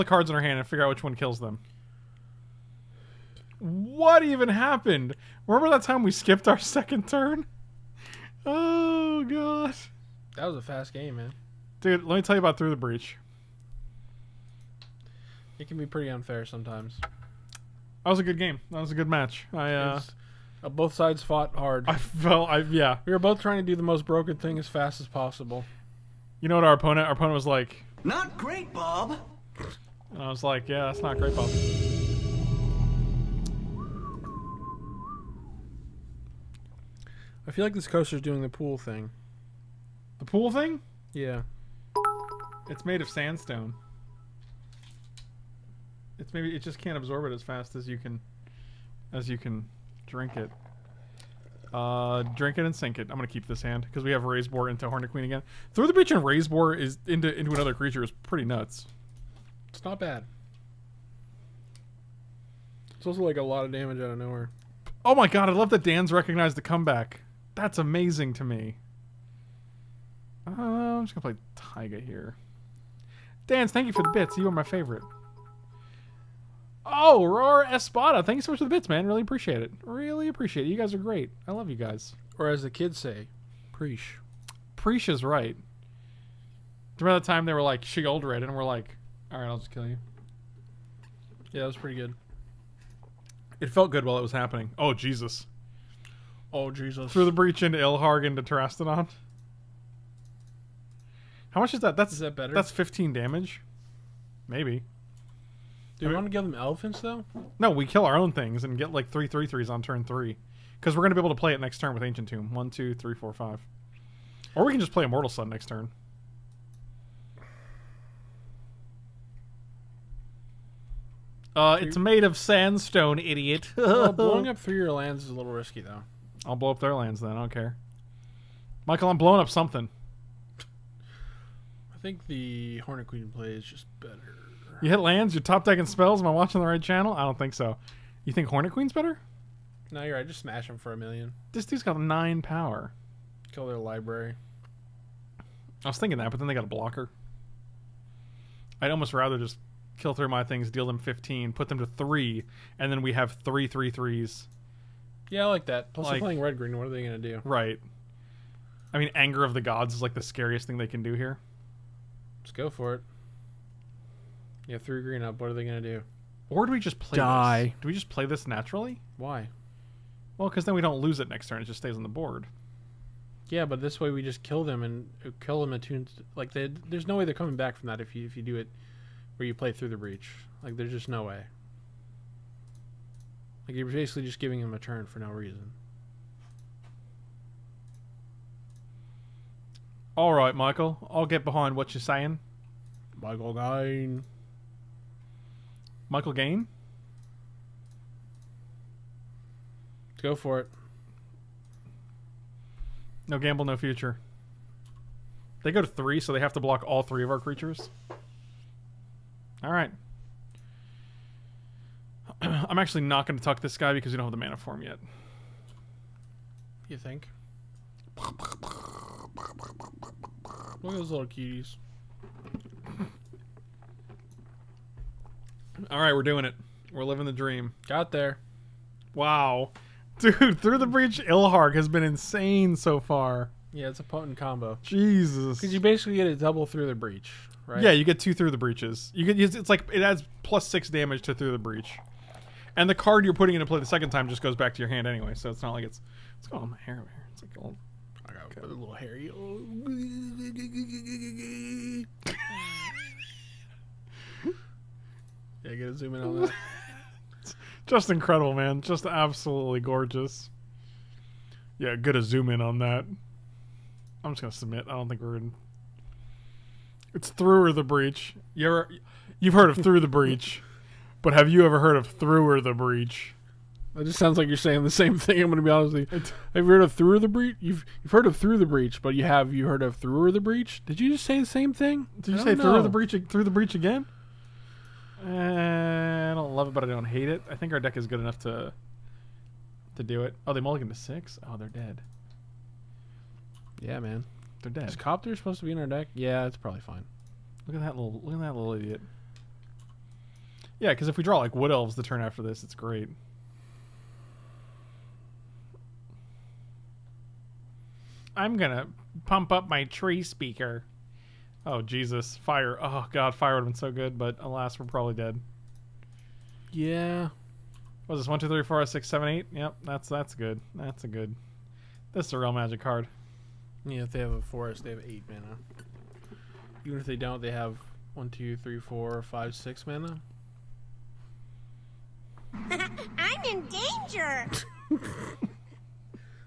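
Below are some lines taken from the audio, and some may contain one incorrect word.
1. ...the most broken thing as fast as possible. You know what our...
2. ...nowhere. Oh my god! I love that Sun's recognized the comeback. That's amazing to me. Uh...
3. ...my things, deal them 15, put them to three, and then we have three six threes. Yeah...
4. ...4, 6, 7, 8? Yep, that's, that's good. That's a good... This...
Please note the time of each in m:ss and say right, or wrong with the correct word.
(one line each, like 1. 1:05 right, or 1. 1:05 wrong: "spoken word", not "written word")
1. 0:23 right
2. 1:04 wrong: "Dan", not "Sun"
3. 2:30 wrong: "three", not "six"
4. 5:18 right.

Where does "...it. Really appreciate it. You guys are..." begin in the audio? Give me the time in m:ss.
1:19.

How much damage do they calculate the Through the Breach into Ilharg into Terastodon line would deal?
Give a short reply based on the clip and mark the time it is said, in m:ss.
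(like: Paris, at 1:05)
15, at 1:42.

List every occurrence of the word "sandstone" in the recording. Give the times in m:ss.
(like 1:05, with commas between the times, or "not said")
0:43, 2:02.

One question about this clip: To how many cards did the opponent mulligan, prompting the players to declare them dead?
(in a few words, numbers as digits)
6.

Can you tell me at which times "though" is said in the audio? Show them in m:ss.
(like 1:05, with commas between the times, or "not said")
1:46, 2:05.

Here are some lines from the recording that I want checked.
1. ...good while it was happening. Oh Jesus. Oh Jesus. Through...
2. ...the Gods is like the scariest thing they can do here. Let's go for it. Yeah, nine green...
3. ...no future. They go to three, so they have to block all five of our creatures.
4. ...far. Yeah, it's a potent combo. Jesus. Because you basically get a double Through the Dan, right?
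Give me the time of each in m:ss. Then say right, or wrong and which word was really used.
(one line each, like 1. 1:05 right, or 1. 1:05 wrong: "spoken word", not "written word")
1. 1:33 right
2. 2:39 wrong: "three", not "nine"
3. 3:23 wrong: "three", not "five"
4. 3:52 wrong: "Breach", not "Dan".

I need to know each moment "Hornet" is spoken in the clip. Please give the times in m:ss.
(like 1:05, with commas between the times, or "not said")
0:54, 2:12, 2:18.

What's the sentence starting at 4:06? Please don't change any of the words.
It's going my hair over It's like all...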